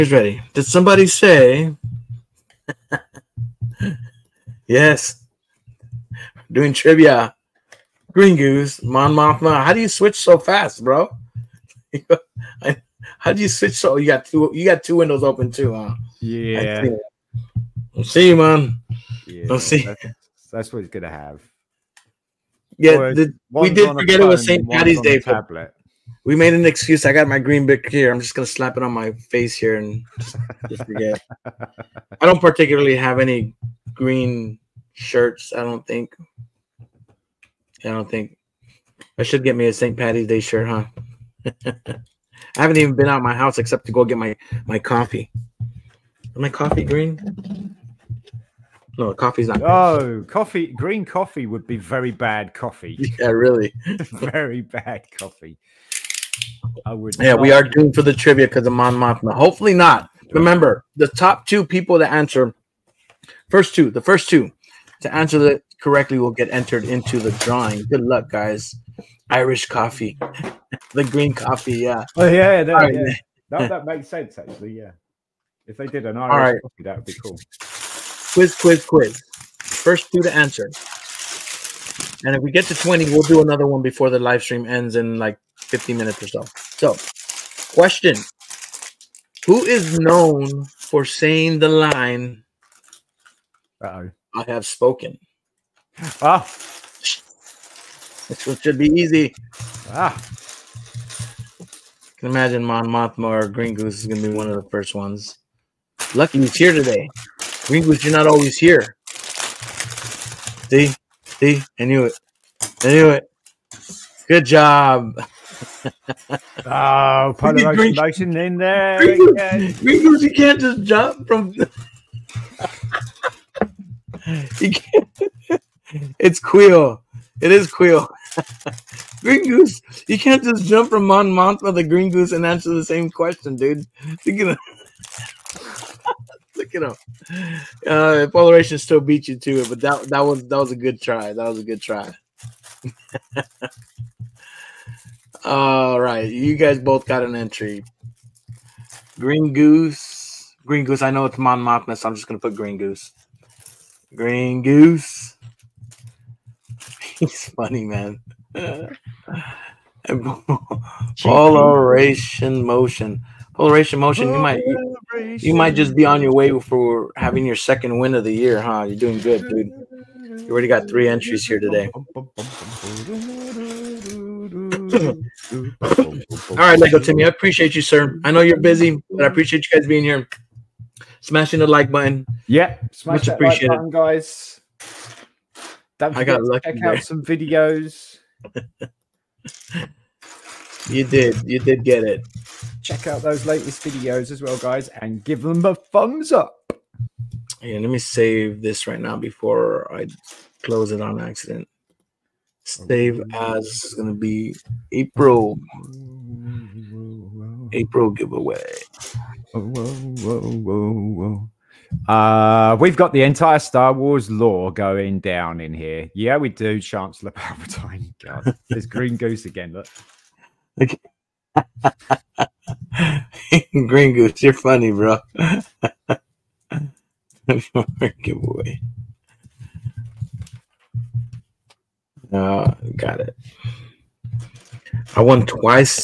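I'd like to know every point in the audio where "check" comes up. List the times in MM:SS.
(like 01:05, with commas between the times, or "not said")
03:06, 03:12.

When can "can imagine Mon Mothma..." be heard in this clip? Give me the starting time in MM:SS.
01:42.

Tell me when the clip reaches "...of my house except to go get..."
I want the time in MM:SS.
00:43.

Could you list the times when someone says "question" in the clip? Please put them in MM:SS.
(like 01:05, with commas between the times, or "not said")
01:27, 02:13.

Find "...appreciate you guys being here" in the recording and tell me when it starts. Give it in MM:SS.
02:59.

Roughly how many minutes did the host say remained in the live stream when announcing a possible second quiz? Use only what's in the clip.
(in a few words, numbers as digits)
50.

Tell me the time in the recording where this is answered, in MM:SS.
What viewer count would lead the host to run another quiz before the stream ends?
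01:22.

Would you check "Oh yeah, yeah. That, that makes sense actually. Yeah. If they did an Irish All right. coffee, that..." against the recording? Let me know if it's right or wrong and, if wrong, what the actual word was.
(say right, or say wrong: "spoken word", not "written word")
right.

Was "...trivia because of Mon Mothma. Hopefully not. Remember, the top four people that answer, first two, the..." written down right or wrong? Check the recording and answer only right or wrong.
wrong.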